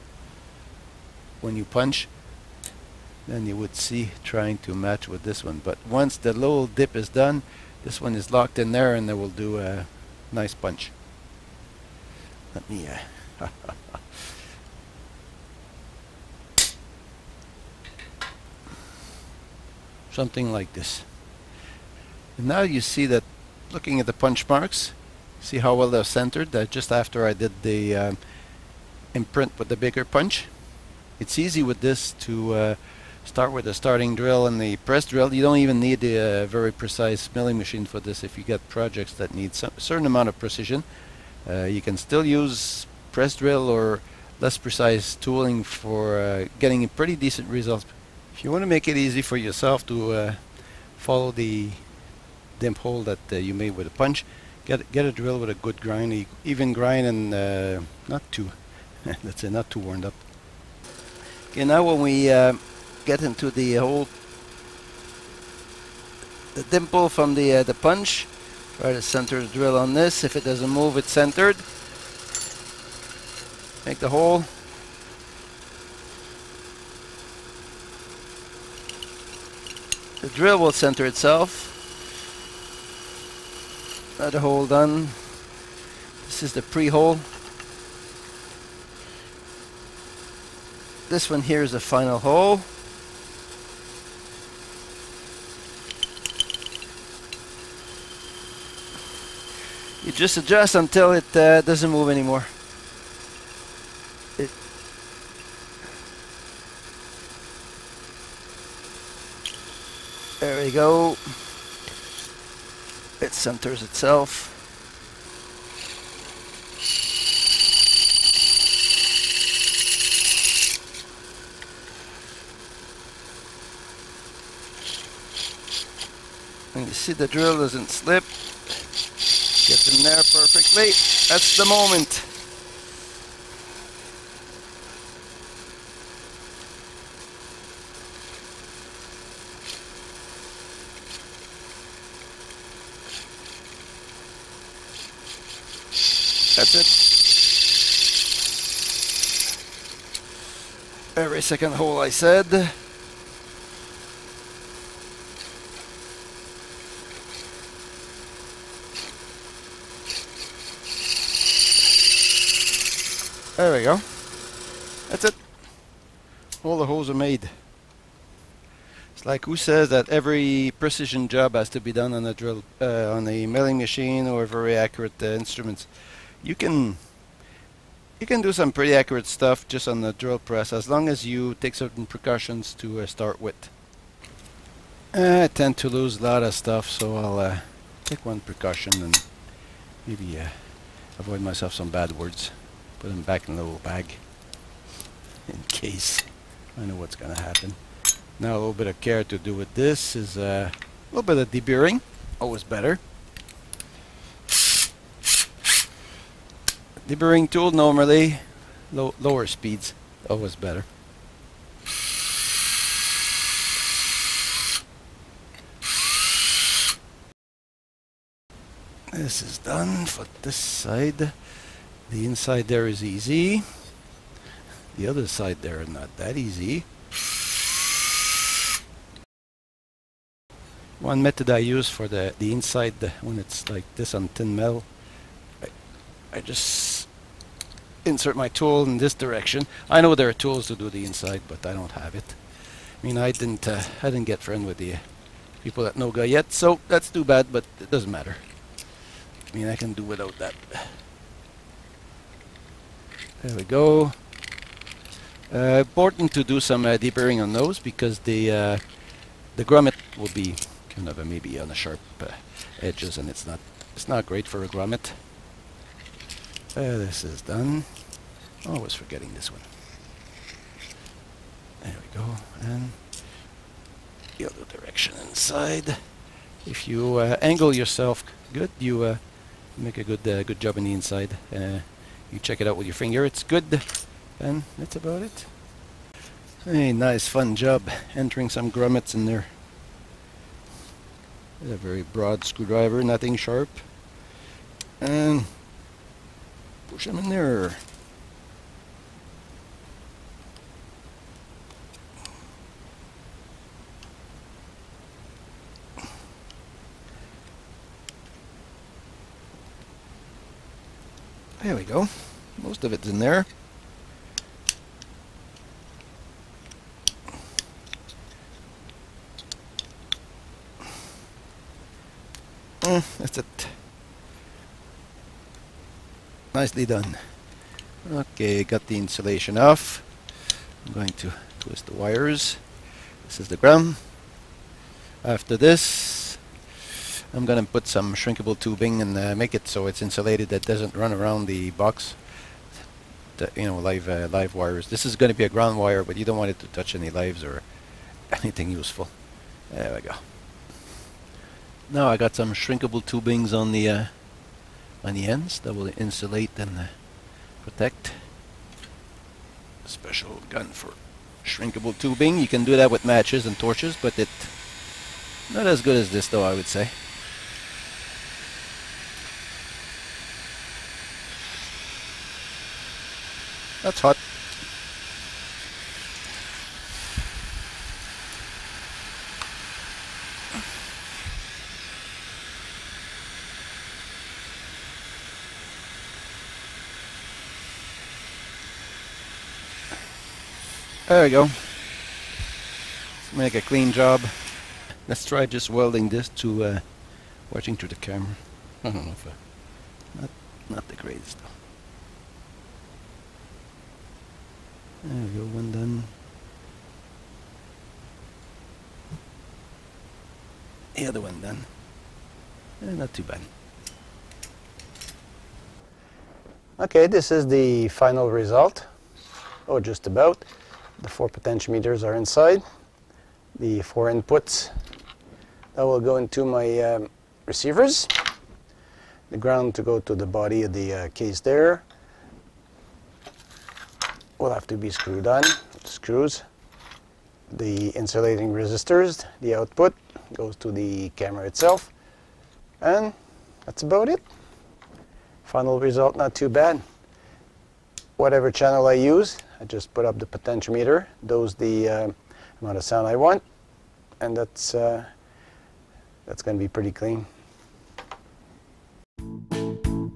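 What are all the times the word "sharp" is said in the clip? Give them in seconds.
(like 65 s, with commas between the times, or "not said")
261 s, 293 s.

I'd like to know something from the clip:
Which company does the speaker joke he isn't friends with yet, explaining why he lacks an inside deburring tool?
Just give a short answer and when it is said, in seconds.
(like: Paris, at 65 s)
Noga, at 245 s.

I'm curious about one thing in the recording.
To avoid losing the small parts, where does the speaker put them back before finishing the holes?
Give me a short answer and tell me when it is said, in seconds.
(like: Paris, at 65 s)
little bag, at 193 s.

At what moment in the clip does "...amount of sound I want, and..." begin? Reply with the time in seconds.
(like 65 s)
452 s.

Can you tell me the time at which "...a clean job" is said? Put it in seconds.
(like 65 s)
393 s.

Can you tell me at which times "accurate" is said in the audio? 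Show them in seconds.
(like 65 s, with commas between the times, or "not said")
174 s, 178 s.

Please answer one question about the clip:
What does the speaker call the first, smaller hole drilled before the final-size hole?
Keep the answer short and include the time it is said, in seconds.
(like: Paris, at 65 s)
pre-hole, at 86 s.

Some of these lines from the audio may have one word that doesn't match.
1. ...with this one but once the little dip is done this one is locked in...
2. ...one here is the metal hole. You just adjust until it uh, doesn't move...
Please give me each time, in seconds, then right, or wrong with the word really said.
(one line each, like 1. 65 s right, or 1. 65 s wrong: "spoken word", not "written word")
1. 5 s right
2. 91 s wrong: "final", not "metal".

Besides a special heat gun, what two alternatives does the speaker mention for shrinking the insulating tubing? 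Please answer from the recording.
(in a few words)
matches and torches.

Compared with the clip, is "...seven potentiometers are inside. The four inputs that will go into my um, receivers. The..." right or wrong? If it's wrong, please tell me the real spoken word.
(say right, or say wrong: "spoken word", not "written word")
wrong: "four", not "seven".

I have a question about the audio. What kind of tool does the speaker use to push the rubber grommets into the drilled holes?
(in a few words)
a very broad screwdriver.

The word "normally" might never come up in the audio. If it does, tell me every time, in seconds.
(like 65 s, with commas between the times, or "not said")
207 s.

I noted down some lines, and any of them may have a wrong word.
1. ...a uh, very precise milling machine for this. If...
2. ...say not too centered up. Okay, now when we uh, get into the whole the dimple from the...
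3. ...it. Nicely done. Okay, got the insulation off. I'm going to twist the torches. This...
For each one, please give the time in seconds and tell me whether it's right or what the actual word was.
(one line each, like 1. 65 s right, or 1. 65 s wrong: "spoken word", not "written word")
1. 36 s right
2. 59 s wrong: "warmed", not "centered"
3. 323 s wrong: "wires", not "torches".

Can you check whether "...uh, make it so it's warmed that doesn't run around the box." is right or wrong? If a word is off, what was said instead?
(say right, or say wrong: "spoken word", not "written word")
wrong: "insulated", not "warmed".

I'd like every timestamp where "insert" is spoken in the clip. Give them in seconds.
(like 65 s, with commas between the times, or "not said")
238 s.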